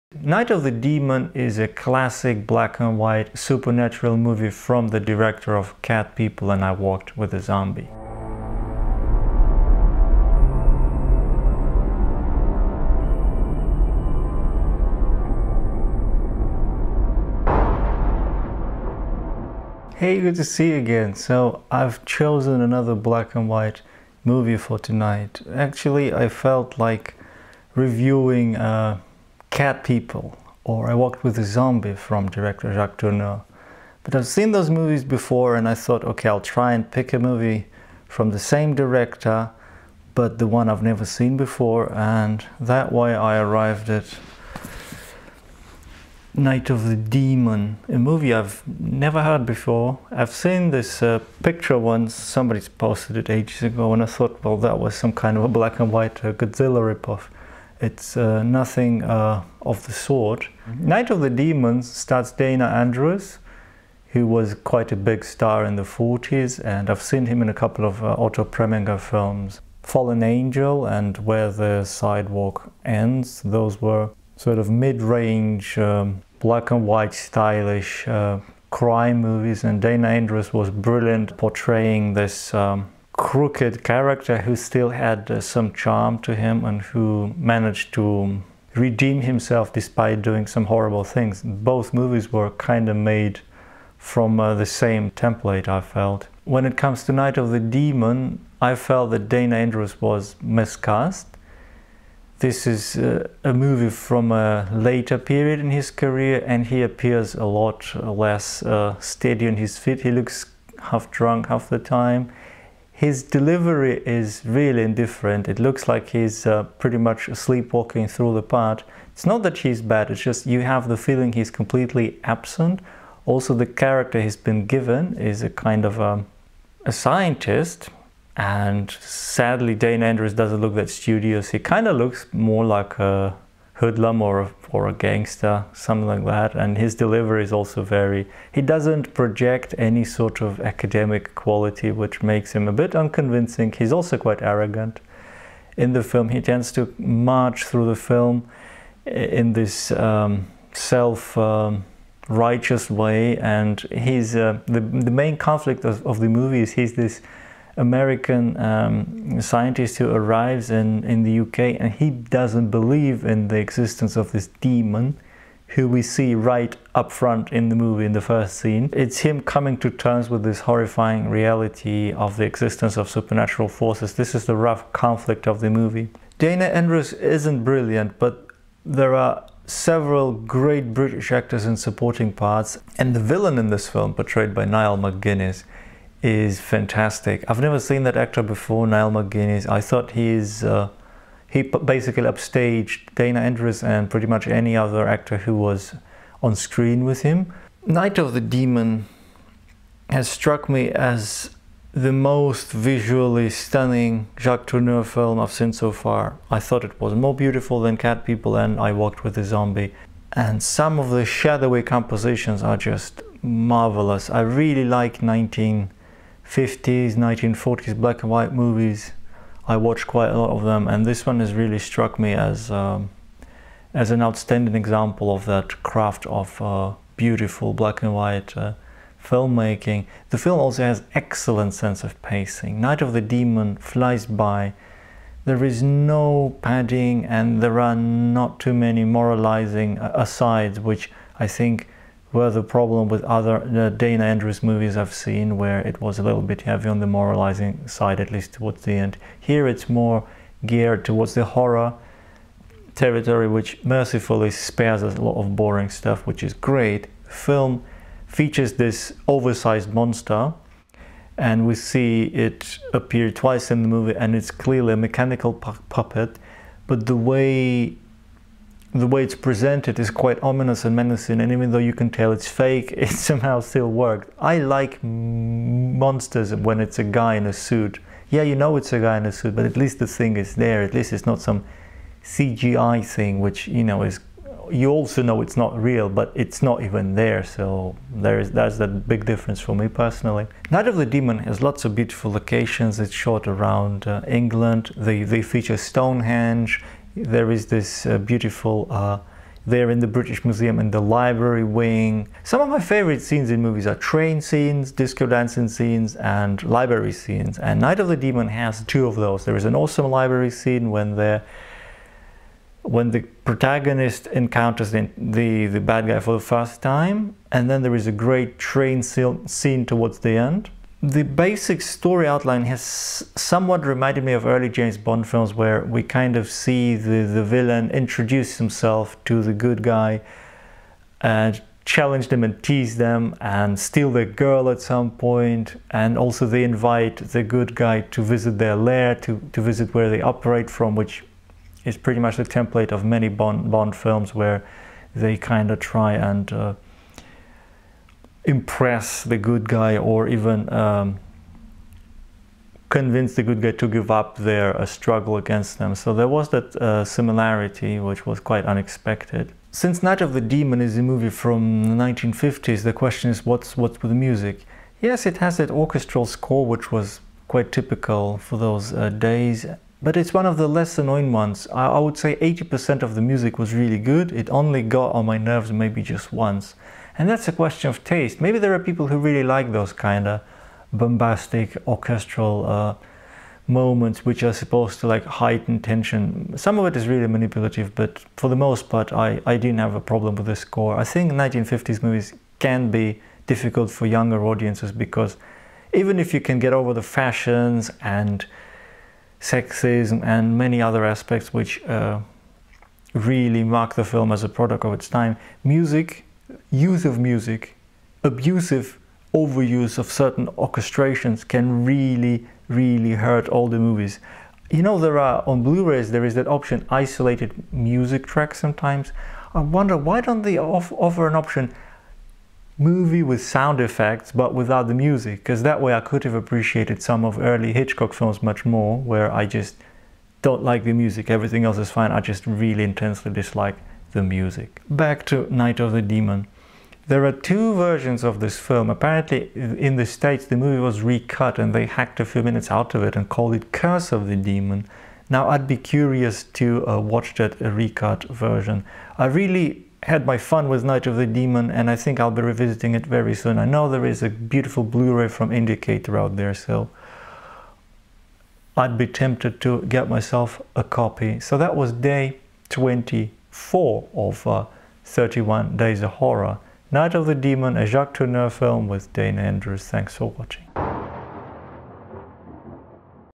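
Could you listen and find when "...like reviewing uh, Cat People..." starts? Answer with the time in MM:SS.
00:26.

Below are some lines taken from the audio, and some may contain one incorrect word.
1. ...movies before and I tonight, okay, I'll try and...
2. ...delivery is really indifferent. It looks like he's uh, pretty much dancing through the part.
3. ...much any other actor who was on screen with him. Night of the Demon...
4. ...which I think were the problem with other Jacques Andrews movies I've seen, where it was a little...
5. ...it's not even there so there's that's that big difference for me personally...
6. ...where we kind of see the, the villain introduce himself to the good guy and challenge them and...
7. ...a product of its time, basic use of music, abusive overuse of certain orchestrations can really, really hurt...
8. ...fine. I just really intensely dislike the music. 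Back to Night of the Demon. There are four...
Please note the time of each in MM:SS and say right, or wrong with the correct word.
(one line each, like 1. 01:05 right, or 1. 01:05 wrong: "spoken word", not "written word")
1. 00:34 wrong: "thought", not "tonight"
2. 01:53 wrong: "sleepwalking", not "dancing"
3. 03:14 right
4. 04:00 wrong: "Dana", not "Jacques"
5. 04:46 right
6. 05:25 right
7. 06:44 wrong: "music", not "basic"
8. 07:11 wrong: "two", not "four".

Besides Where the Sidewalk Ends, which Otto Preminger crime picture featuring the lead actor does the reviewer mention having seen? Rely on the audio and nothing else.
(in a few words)
Fallen Angel.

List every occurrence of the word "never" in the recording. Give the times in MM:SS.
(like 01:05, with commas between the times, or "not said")
00:40, 00:48, 03:07.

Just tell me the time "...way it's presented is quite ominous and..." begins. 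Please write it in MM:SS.
04:29.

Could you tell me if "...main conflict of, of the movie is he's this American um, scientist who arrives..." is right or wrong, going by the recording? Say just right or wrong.
right.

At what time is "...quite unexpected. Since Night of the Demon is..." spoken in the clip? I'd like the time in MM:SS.
05:58.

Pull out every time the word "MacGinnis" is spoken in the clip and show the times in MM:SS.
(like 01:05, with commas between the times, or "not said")
03:04, 03:09.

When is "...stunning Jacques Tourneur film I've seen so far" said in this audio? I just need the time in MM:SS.
03:23.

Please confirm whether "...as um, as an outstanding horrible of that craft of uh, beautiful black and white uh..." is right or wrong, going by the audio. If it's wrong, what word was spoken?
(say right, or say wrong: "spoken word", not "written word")
wrong: "example", not "horrible".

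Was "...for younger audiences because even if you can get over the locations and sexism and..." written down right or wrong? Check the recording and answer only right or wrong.
wrong.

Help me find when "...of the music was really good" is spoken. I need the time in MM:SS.
06:13.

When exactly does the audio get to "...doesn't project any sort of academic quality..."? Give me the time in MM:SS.
02:18.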